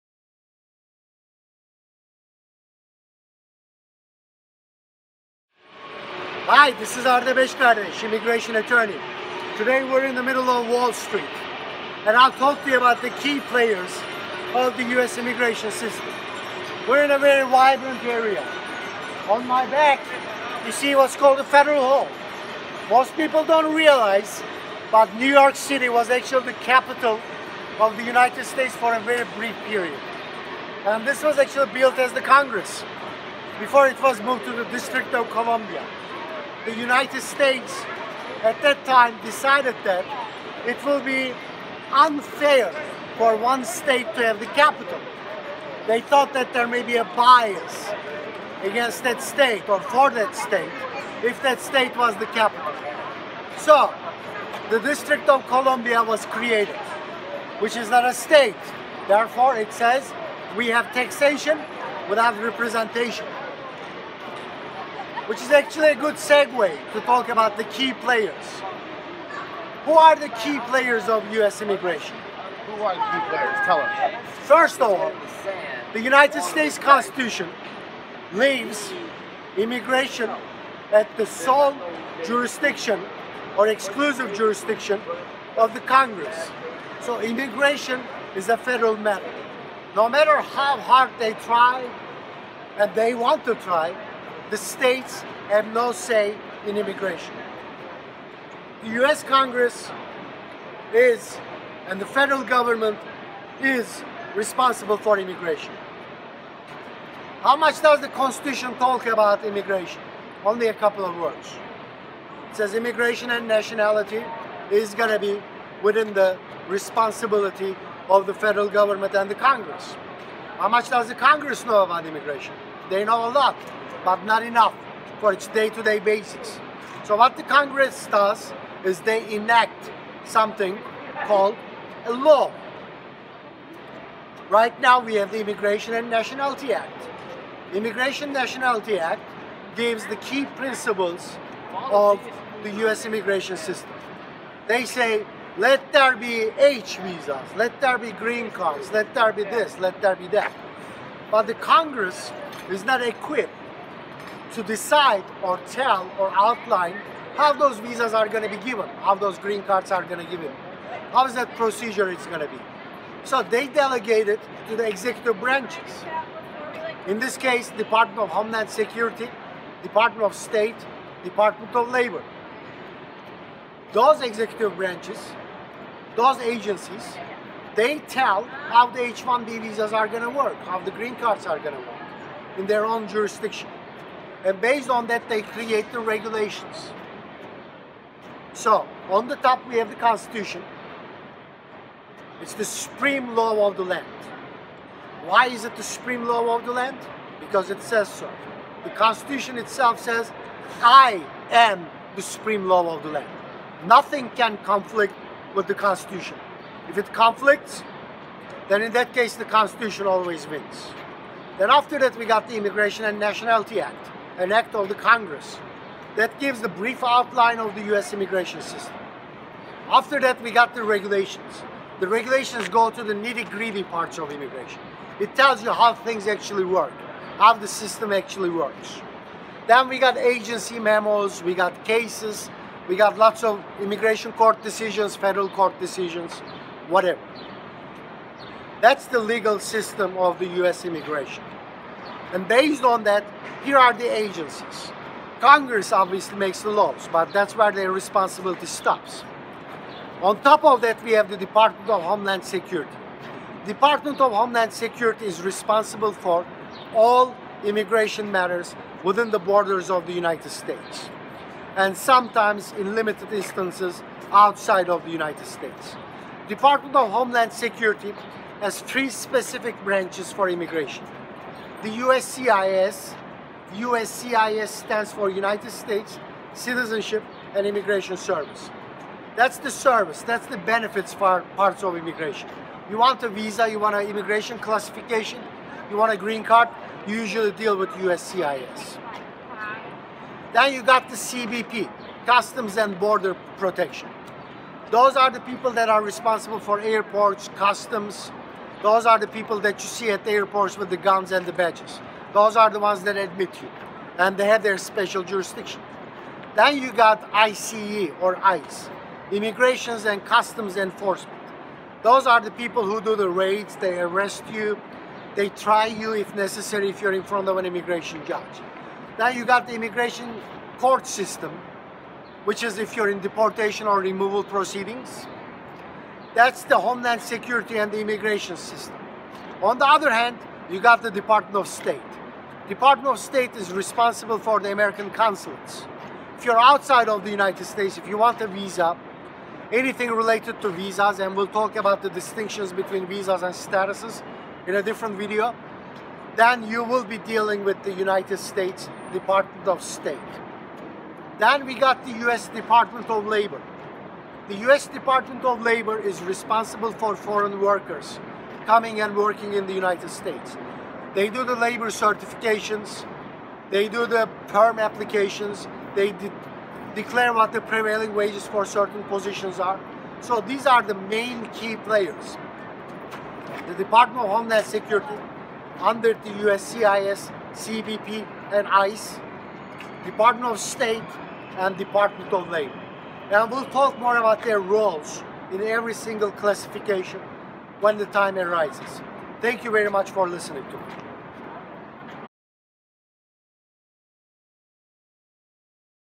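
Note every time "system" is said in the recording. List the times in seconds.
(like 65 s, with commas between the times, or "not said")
15 s, 143 s, 218 s, 227 s, 239 s, 321 s, 328 s.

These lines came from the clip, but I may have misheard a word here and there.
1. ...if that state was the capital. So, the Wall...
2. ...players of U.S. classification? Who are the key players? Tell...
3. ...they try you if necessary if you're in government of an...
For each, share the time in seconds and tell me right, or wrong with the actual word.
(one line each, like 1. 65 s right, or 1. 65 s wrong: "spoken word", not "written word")
1. 51 s wrong: "District", not "Wall"
2. 70 s wrong: "immigration", not "classification"
3. 315 s wrong: "front", not "government".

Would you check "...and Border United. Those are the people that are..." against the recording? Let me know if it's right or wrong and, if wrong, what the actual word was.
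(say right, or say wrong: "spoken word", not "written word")
wrong: "Protection", not "United".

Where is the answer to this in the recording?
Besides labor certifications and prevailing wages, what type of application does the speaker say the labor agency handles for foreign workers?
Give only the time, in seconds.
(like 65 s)
364 s.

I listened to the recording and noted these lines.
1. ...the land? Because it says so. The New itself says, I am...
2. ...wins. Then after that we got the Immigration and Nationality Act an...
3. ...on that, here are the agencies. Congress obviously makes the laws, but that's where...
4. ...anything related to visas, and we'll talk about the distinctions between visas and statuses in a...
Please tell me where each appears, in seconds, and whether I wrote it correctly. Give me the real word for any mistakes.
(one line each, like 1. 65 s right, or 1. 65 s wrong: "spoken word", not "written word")
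1. 196 s wrong: "Constitution", not "New"
2. 210 s right
3. 242 s right
4. 339 s right.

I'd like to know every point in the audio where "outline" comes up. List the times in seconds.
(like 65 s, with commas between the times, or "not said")
156 s, 217 s.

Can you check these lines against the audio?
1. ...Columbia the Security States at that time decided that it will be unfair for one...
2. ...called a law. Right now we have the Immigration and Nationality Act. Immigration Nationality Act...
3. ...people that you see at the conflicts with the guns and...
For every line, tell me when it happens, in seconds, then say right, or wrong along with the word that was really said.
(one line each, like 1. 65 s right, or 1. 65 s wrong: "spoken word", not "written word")
1. 35 s wrong: "United", not "Security"
2. 131 s right
3. 299 s wrong: "airports", not "conflicts".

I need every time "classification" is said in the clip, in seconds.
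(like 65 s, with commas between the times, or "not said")
284 s, 386 s.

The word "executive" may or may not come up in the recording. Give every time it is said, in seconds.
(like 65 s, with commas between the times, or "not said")
164 s, 174 s.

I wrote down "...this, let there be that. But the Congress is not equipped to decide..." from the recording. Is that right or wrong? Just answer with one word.
right.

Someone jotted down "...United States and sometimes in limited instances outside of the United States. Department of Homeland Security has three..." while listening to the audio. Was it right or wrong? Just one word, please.
right.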